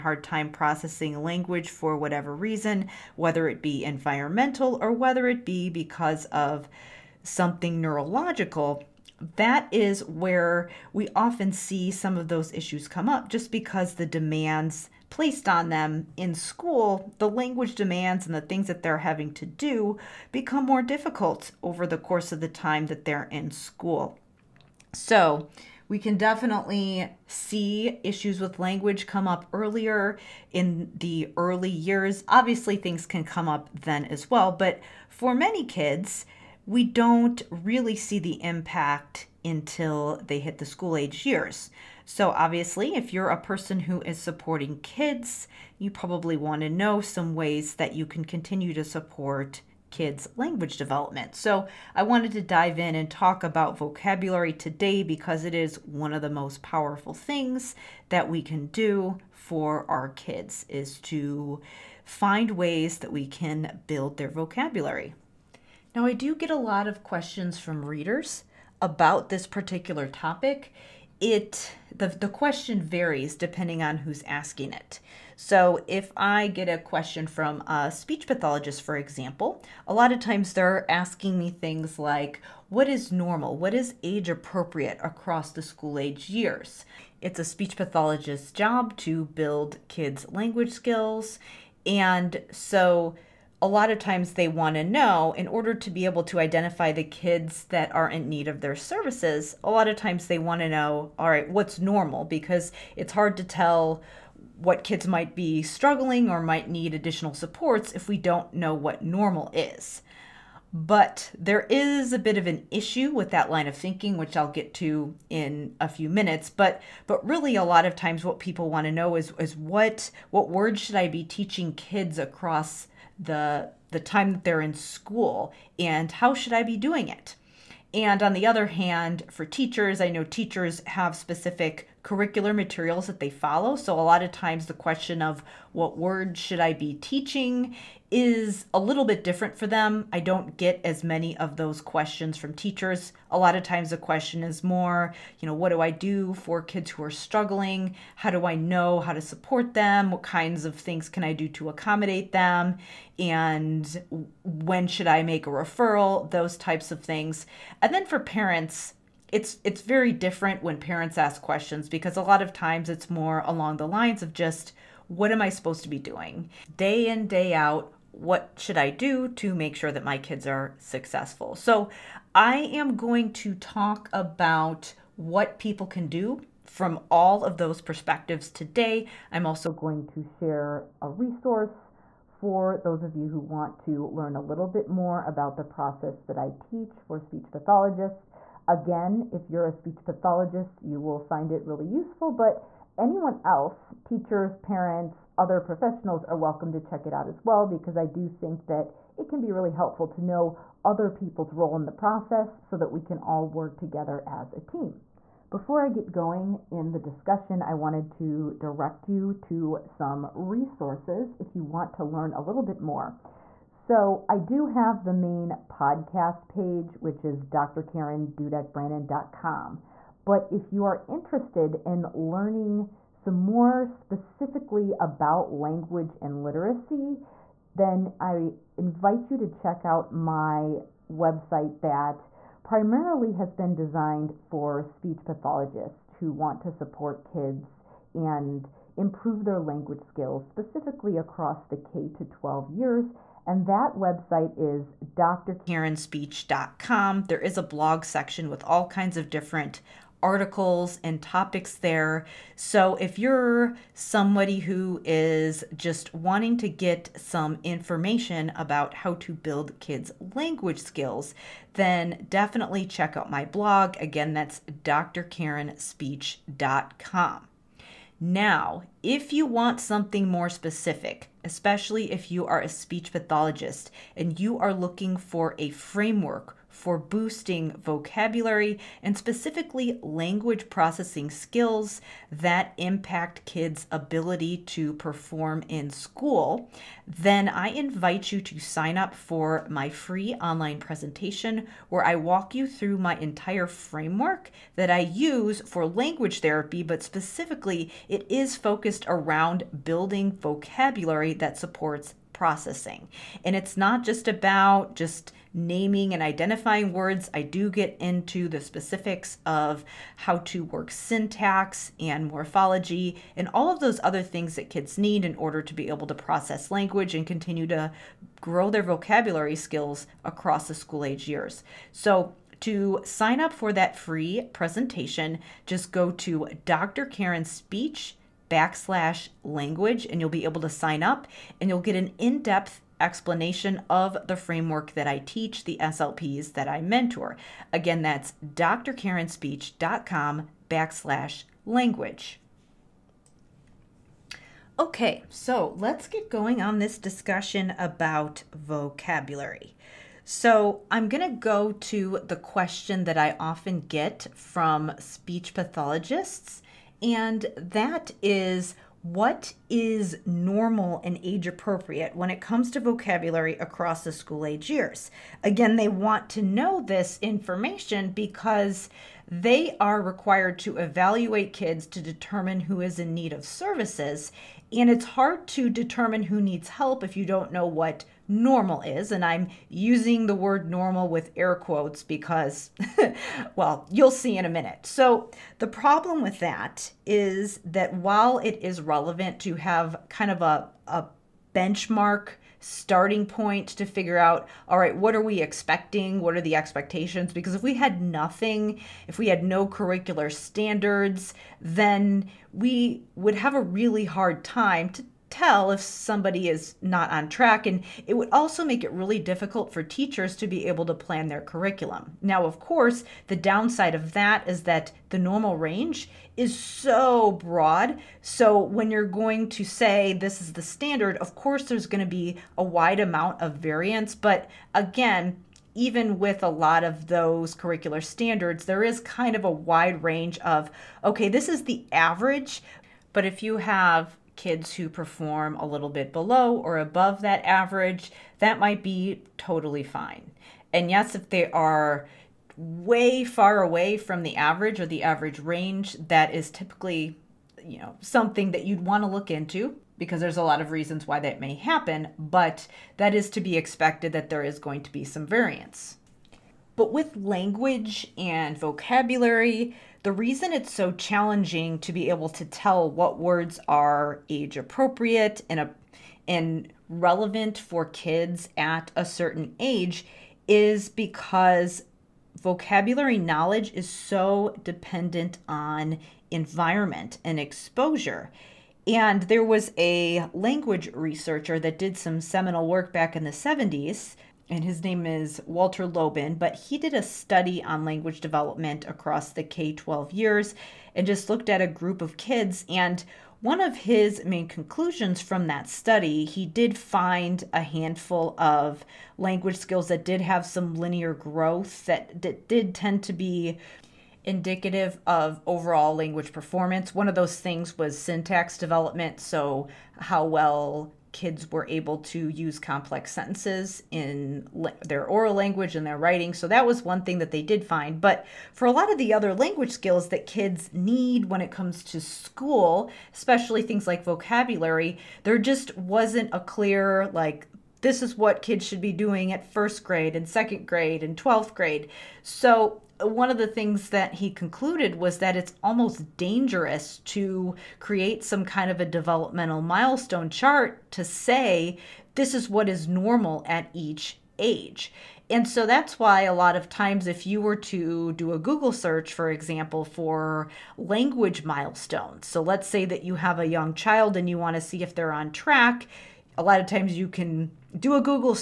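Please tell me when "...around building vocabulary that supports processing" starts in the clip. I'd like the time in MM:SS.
04:59.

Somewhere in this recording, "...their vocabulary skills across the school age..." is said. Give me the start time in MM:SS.
05:18.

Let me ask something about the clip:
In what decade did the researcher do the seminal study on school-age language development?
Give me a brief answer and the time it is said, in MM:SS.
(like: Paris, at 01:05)
the 70s, at 08:03.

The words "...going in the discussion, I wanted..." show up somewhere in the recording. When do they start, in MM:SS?
03:26.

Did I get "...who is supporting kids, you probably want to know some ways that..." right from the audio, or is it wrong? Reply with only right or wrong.
right.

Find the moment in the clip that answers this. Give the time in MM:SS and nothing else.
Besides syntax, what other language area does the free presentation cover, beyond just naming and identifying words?
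05:12.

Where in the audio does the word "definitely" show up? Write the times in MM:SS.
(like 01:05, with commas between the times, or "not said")
00:26, 04:22.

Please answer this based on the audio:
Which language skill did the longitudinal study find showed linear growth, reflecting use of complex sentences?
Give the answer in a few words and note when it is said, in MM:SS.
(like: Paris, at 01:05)
syntax development, at 08:27.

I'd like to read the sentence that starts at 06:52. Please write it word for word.
Now, of course, the downside of that is that the normal range is so broad.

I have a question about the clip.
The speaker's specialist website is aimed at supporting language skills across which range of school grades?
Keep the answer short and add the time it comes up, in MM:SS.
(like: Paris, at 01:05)
K to 12, at 04:01.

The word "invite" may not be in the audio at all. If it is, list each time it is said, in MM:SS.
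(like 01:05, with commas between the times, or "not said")
03:48, 04:47.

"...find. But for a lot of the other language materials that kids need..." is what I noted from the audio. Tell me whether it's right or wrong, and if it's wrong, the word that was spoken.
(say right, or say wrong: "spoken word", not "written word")
wrong: "skills", not "materials".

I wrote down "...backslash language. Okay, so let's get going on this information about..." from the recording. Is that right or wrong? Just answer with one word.
wrong.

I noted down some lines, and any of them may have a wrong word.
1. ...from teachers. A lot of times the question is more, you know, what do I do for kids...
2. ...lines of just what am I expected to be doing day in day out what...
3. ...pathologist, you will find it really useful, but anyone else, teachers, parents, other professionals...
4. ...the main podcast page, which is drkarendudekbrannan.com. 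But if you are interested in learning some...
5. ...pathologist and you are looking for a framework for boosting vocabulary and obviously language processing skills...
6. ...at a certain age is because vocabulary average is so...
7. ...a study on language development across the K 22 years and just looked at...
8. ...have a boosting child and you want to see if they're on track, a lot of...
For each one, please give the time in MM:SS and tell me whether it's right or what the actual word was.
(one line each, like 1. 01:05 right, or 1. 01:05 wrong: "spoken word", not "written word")
1. 02:22 right
2. 02:43 wrong: "supposed", not "expected"
3. 03:10 right
4. 03:35 right
5. 04:33 wrong: "specifically", not "obviously"
6. 07:48 wrong: "knowledge", not "average"
7. 08:06 wrong: "12", not "22"
8. 09:13 wrong: "young", not "boosting".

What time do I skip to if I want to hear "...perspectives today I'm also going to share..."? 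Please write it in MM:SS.
02:57.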